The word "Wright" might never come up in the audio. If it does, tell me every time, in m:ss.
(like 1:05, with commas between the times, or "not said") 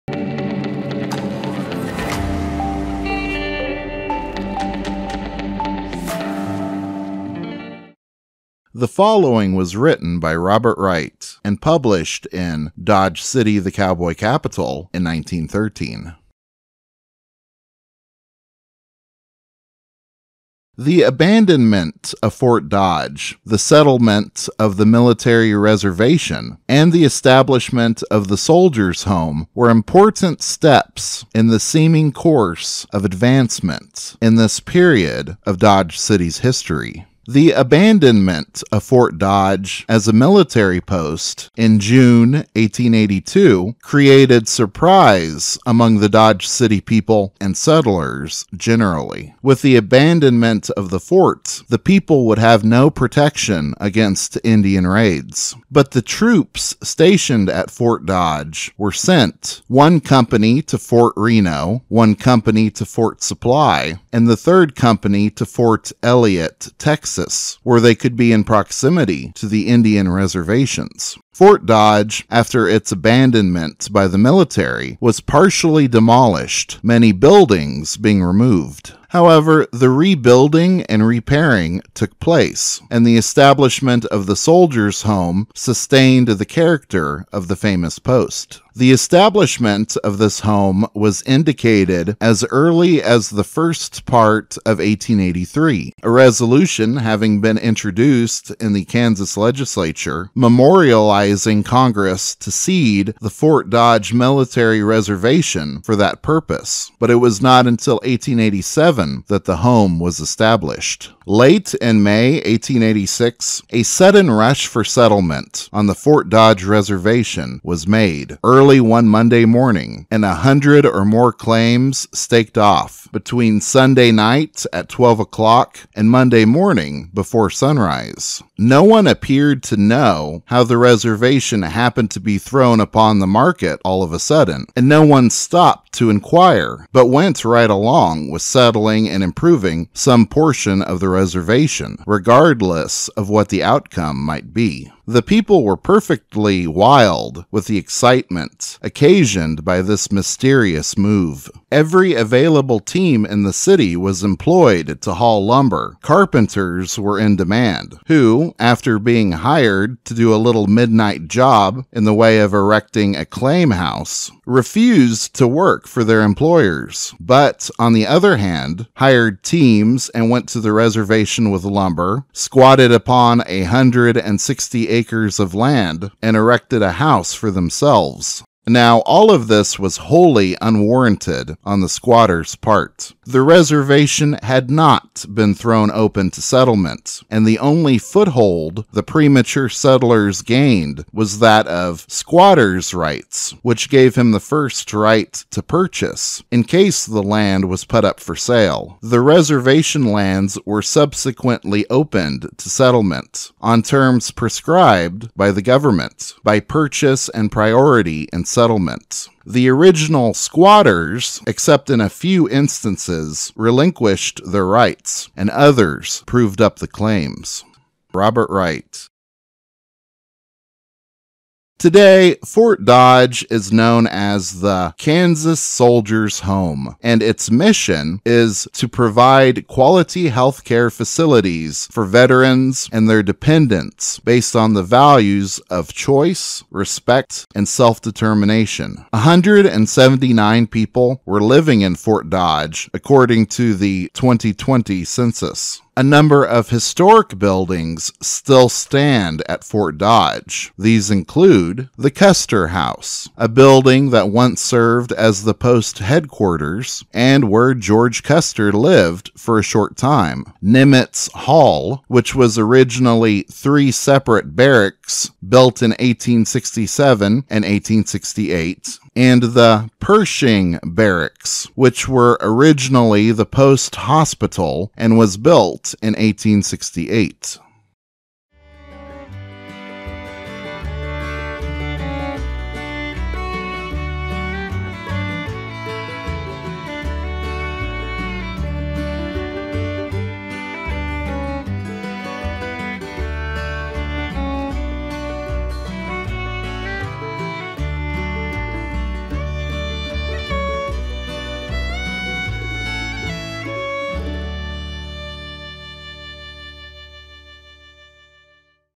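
0:10, 3:38.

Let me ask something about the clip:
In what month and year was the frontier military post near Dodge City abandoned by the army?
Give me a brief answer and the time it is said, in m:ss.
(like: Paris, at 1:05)
June 1882, at 0:41.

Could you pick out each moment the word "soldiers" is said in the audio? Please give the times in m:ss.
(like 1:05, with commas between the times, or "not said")
0:28, 1:24, 3:45.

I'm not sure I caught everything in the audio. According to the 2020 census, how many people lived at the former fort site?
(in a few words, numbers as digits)
179.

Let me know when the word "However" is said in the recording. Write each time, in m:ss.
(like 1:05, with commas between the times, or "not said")
1:19.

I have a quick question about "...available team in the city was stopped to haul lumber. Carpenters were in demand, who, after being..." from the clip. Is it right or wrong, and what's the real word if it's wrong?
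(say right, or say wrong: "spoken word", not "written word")
wrong: "employed", not "stopped".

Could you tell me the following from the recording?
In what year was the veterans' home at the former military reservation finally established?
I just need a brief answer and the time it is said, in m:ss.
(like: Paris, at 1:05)
1887, at 1:47.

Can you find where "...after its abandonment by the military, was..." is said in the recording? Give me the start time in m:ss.
1:12.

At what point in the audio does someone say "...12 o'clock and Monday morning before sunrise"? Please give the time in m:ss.
2:04.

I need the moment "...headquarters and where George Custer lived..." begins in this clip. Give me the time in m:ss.
4:15.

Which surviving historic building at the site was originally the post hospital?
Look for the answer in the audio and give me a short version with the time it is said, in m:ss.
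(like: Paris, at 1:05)
Pershing Barracks, at 4:29.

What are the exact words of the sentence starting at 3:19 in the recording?
The reservation lands were subsequently opened to settlement on terms prescribed by the government by purchase and priority in settlements.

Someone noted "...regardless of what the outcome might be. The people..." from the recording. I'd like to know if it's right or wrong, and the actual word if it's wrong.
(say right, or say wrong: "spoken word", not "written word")
right.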